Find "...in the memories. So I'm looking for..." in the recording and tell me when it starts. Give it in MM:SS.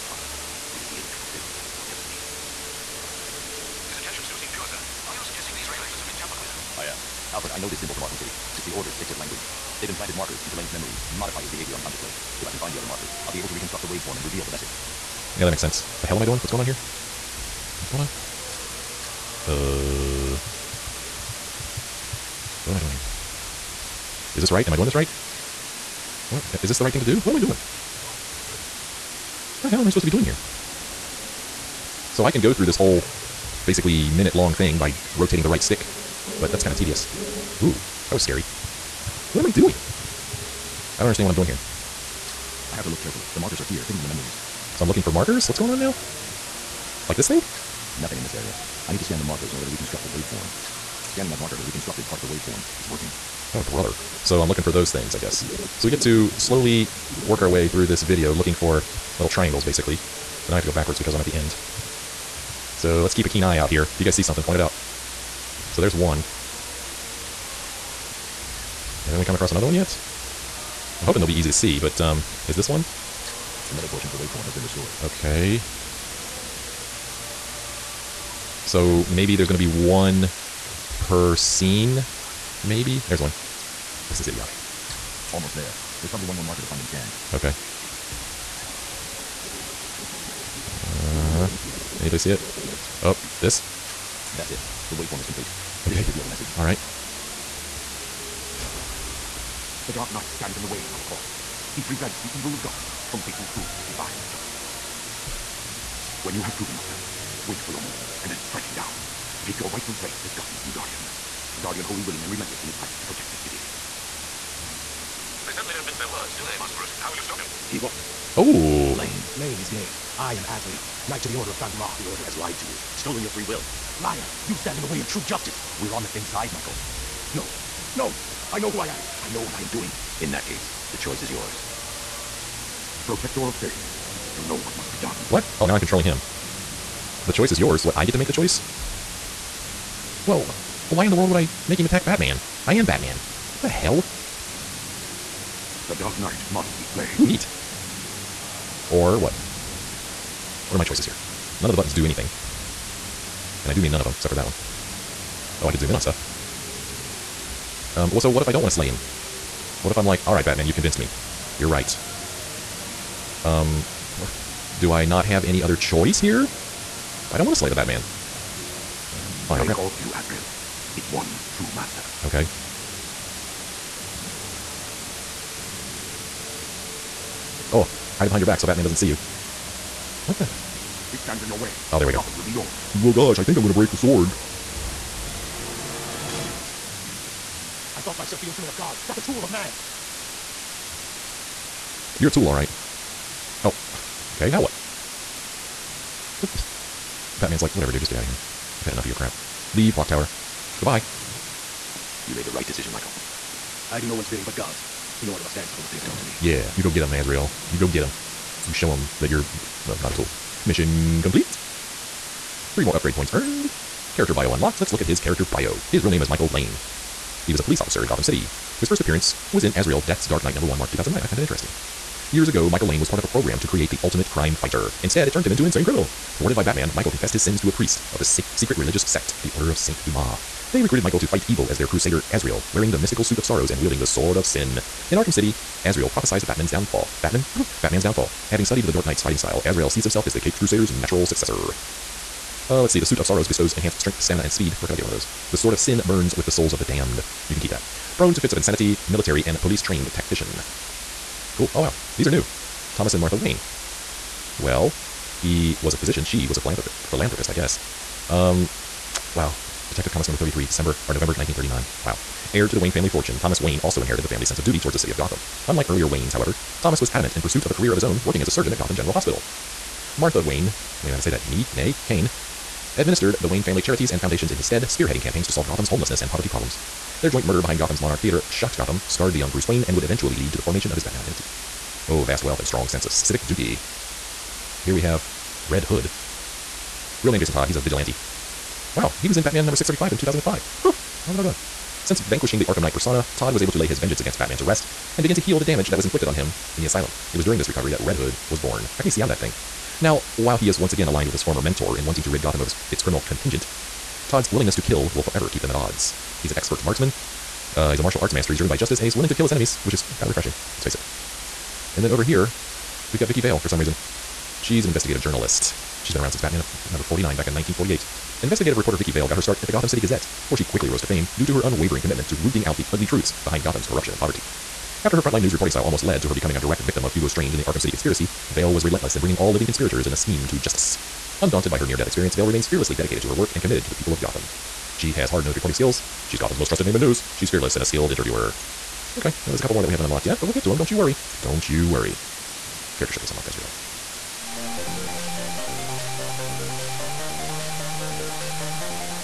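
00:43.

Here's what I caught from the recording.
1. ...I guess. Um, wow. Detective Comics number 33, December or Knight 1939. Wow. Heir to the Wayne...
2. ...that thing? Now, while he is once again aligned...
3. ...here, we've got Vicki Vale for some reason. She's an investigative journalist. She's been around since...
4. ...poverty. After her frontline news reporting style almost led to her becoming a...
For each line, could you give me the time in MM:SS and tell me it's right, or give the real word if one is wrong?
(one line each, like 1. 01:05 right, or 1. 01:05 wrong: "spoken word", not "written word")
1. 04:17 wrong: "November", not "Knight"
2. 04:59 right
3. 05:12 right
4. 05:24 right.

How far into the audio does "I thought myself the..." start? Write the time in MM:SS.
03:07.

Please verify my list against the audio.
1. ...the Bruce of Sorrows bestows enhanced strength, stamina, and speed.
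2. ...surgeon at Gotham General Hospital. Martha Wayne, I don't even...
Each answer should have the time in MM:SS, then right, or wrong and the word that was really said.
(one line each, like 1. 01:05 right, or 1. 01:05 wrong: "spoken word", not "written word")
1. 04:02 wrong: "Suit", not "Bruce"
2. 04:28 right.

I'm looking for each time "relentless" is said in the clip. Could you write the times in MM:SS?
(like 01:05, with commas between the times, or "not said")
01:52, 05:28.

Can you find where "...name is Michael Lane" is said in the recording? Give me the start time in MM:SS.
03:36.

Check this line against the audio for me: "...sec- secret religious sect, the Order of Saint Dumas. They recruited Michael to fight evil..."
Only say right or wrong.
right.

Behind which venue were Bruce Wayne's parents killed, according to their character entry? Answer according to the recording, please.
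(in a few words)
Monarch Theater.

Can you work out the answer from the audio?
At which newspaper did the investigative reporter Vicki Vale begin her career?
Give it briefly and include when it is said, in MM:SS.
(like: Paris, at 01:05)
Gotham City Gazette, at 05:19.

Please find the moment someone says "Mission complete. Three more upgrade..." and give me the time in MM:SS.
03:30.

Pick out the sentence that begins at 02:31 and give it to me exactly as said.
None of the buttons do anything.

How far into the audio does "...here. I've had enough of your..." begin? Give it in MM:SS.
03:18.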